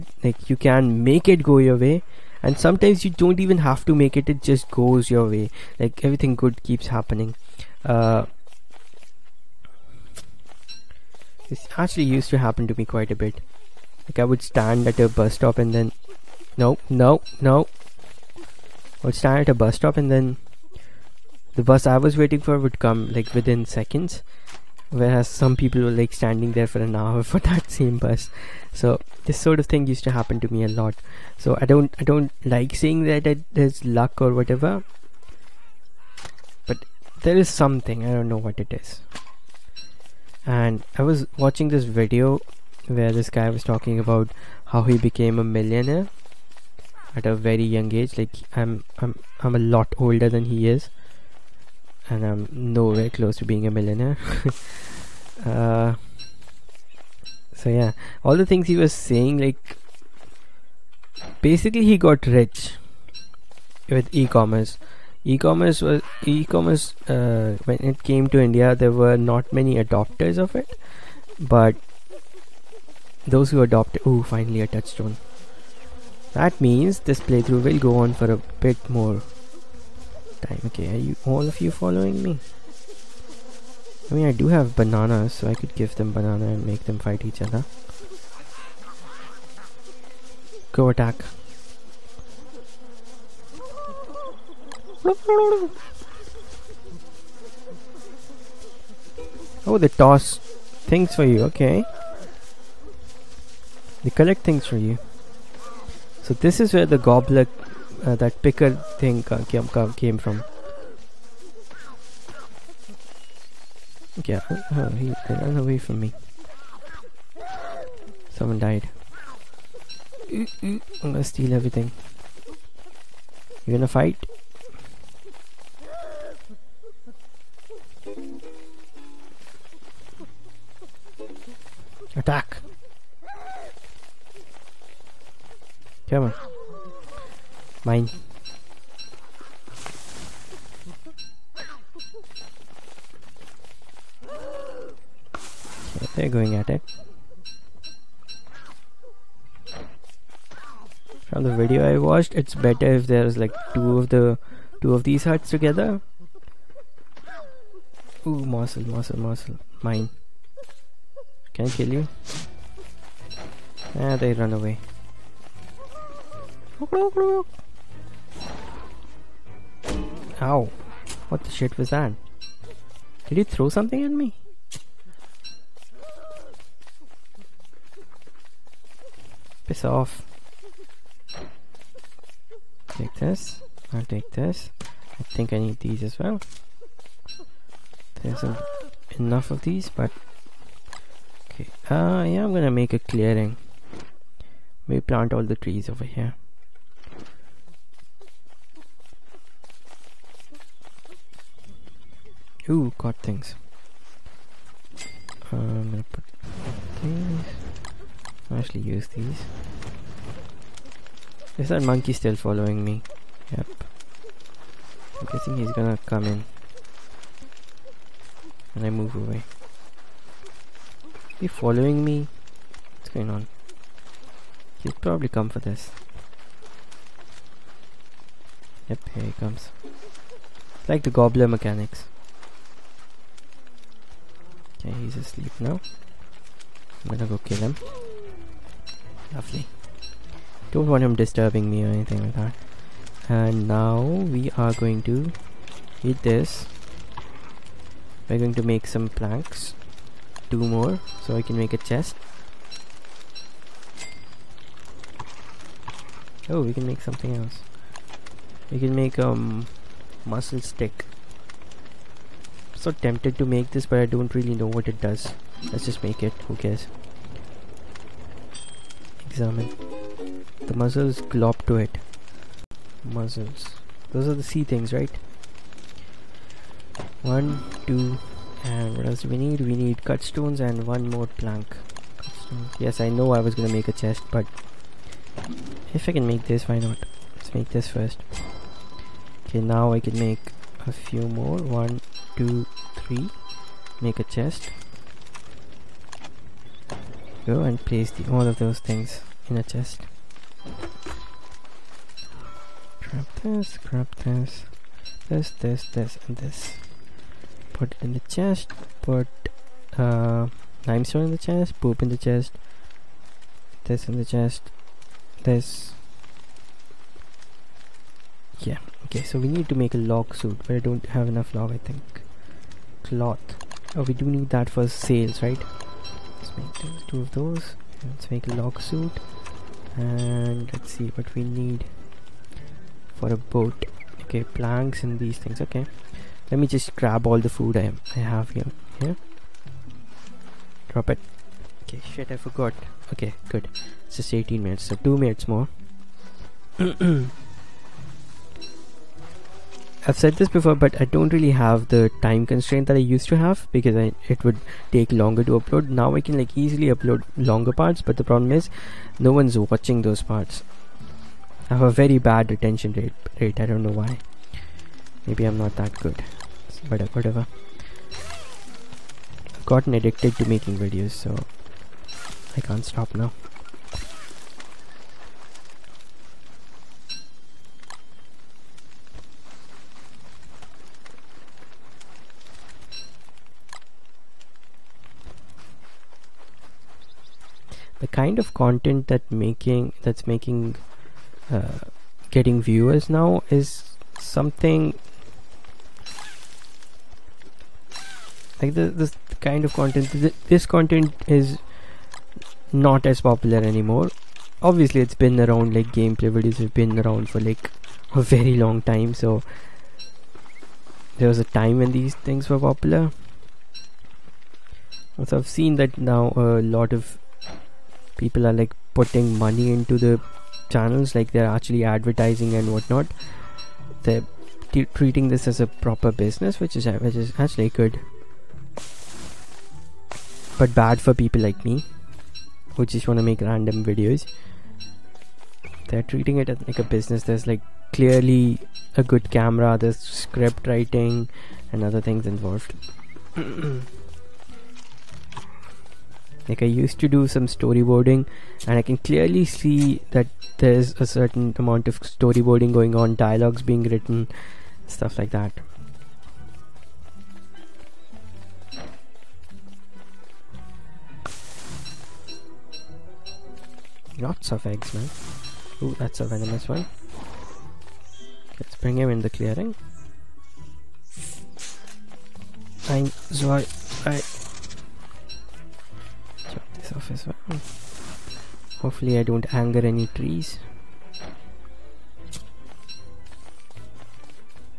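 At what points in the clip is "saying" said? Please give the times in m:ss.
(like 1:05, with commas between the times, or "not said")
0:32, 0:58.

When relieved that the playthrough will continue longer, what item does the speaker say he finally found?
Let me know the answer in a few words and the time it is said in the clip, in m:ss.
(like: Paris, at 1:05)
Touchstone, at 1:14.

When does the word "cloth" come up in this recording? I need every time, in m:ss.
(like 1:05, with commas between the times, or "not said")
5:23.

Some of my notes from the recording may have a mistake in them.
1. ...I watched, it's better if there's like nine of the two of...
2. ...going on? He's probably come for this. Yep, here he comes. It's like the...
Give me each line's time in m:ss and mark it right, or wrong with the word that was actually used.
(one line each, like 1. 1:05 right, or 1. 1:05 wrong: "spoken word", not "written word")
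1. 2:31 wrong: "two", not "nine"
2. 3:43 right.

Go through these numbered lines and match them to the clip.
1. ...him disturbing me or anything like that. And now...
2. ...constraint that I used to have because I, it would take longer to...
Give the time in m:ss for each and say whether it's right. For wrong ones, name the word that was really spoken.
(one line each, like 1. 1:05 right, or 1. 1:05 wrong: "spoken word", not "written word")
1. 4:01 right
2. 5:52 right.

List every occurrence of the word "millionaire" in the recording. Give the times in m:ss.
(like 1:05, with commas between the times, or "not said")
0:45, 0:53.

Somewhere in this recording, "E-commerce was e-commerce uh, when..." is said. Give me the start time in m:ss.
1:05.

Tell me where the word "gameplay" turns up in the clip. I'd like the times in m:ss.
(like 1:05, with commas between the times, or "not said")
6:45.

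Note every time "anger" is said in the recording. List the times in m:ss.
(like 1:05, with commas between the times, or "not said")
7:59.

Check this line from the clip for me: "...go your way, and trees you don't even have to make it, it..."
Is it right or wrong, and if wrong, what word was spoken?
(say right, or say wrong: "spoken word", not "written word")
wrong: "sometimes", not "trees".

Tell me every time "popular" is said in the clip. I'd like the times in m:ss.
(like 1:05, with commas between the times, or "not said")
6:43, 6:52.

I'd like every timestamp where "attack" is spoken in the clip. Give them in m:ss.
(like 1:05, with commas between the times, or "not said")
1:30, 2:12.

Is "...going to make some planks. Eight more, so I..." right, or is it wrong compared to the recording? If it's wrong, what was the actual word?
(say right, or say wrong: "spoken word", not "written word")
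wrong: "Two", not "Eight".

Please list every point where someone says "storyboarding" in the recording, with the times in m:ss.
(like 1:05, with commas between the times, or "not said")
7:27, 7:32.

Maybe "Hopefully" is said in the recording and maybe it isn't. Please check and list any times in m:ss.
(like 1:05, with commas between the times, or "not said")
7:58.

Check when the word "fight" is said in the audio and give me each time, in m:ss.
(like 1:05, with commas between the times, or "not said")
1:26, 2:03.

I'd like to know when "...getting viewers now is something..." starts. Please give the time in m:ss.
6:32.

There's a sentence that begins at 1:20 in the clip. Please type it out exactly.
Okay, are you all of you following me?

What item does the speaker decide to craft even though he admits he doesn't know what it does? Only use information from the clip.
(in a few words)
Mussel stick.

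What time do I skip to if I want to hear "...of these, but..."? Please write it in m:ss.
3:09.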